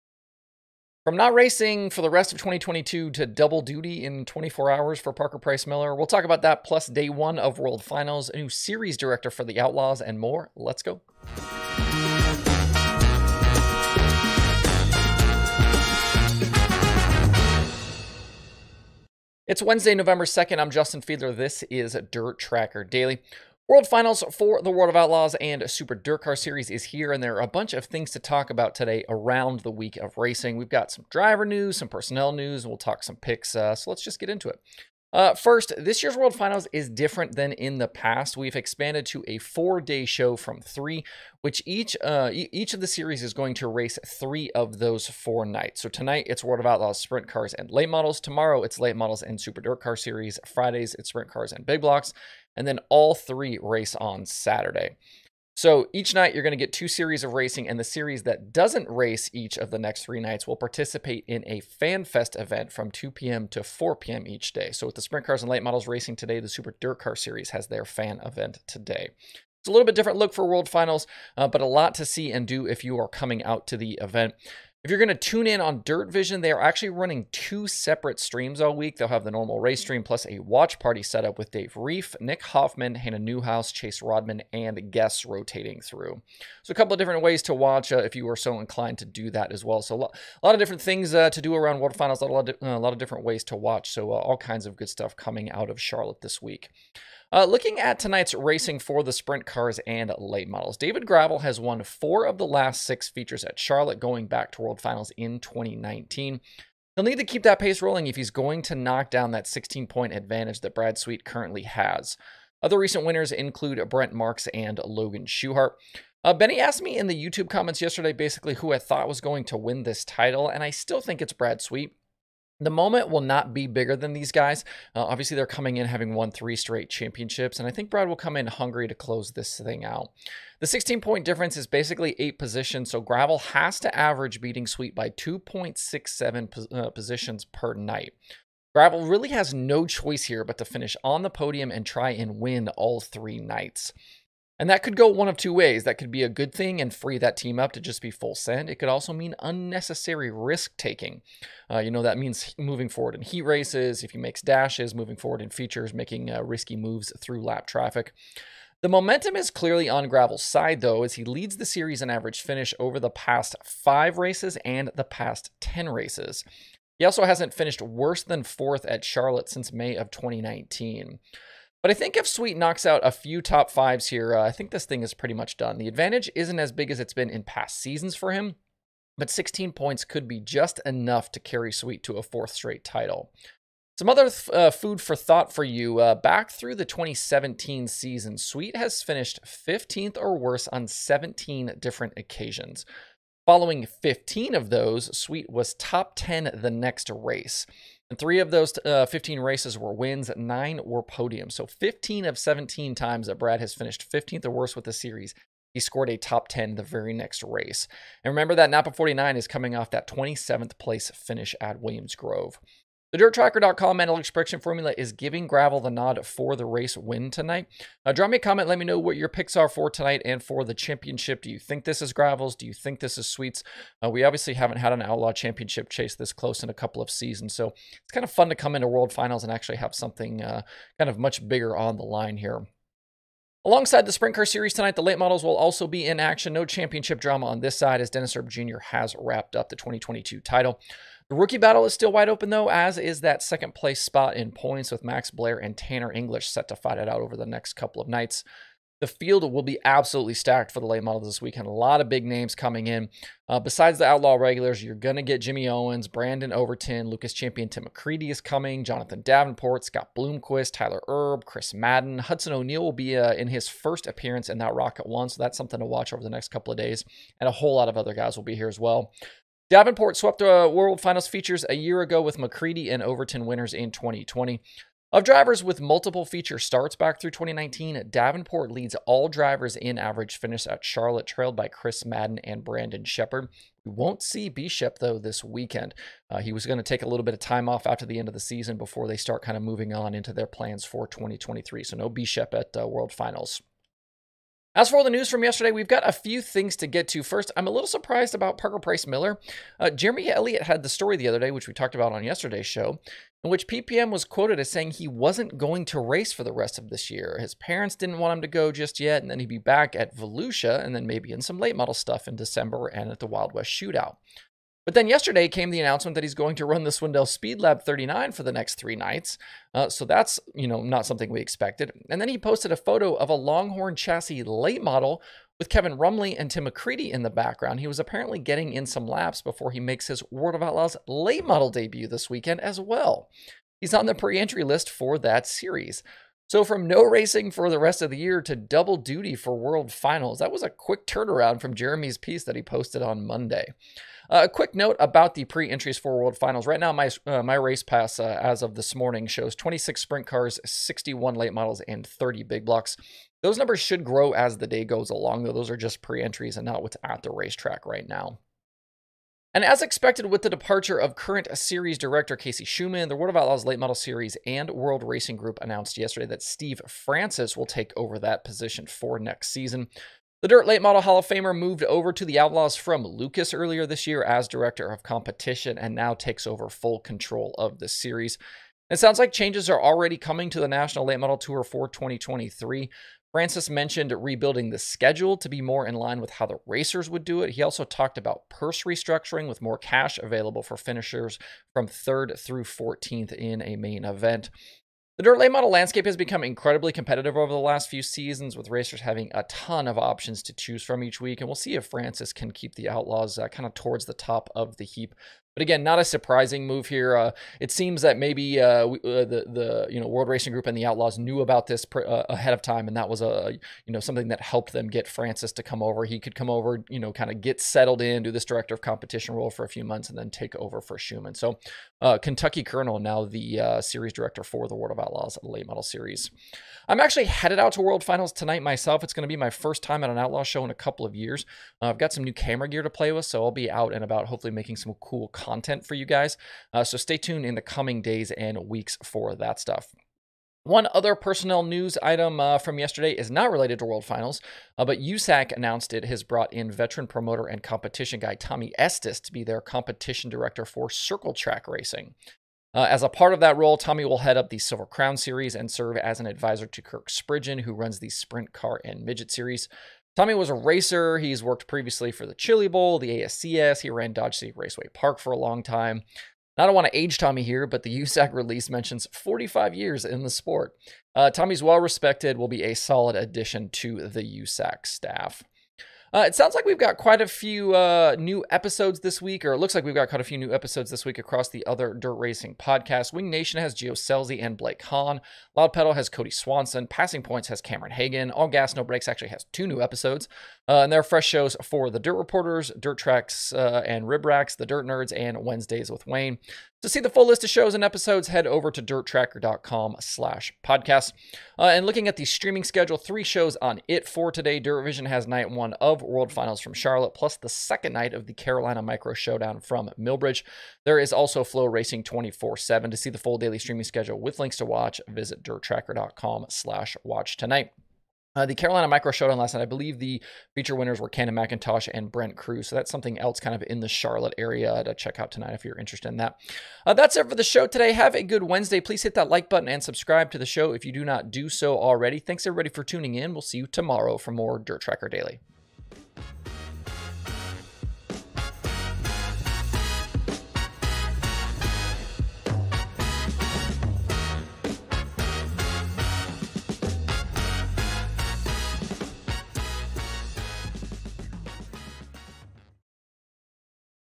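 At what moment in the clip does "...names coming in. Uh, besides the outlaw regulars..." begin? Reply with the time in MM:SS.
04:12.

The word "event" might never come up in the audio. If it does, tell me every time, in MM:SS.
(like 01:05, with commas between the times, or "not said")
01:02, 01:08, 01:14, 06:34.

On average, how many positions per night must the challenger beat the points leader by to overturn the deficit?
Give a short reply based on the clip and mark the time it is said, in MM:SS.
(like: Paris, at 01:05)
2.67, at 02:15.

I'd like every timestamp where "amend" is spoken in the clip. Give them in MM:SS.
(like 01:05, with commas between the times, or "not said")
not said.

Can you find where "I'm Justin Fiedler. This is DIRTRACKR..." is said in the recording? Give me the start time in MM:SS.
00:20.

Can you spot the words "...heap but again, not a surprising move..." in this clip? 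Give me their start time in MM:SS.
06:44.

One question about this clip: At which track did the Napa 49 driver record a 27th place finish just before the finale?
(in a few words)
Williams Grove.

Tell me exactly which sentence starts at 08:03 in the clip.
Wing Nation has Gio Scelzi and Blake Hahn.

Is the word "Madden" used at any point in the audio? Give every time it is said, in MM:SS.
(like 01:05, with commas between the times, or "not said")
04:21, 04:42.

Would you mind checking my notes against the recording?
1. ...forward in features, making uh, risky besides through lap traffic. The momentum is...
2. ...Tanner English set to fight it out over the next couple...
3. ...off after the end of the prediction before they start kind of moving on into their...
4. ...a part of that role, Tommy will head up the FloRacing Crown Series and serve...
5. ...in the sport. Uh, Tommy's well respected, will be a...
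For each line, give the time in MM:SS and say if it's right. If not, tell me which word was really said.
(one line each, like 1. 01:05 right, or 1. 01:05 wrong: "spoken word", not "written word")
1. 02:35 wrong: "moves", not "besides"
2. 04:05 right
3. 04:47 wrong: "season", not "prediction"
4. 07:33 wrong: "Silver", not "FloRacing"
5. 07:50 right.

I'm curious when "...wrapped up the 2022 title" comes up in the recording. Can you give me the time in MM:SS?
03:59.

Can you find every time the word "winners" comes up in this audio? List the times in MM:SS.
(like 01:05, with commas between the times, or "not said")
01:53, 04:33, 08:40.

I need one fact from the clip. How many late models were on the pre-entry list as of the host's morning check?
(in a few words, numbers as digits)
61.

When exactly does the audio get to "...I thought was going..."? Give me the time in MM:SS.
01:58.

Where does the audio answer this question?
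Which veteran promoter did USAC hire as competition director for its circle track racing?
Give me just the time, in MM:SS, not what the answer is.
07:28.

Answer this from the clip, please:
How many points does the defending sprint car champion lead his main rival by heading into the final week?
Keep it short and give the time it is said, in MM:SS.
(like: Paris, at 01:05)
16, at 01:49.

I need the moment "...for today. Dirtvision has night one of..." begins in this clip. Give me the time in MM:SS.
08:24.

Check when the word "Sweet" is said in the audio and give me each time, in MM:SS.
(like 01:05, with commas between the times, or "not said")
01:50, 02:01, 02:14, 02:52, 03:01, 03:08, 03:15, 03:43.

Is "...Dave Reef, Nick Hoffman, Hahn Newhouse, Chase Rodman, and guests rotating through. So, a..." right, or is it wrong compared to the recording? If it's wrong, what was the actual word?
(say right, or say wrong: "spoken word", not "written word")
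wrong: "Hannah", not "Hahn".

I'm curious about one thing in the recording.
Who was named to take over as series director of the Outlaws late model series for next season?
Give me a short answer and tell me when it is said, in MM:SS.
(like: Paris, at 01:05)
Steve Francis, at 06:06.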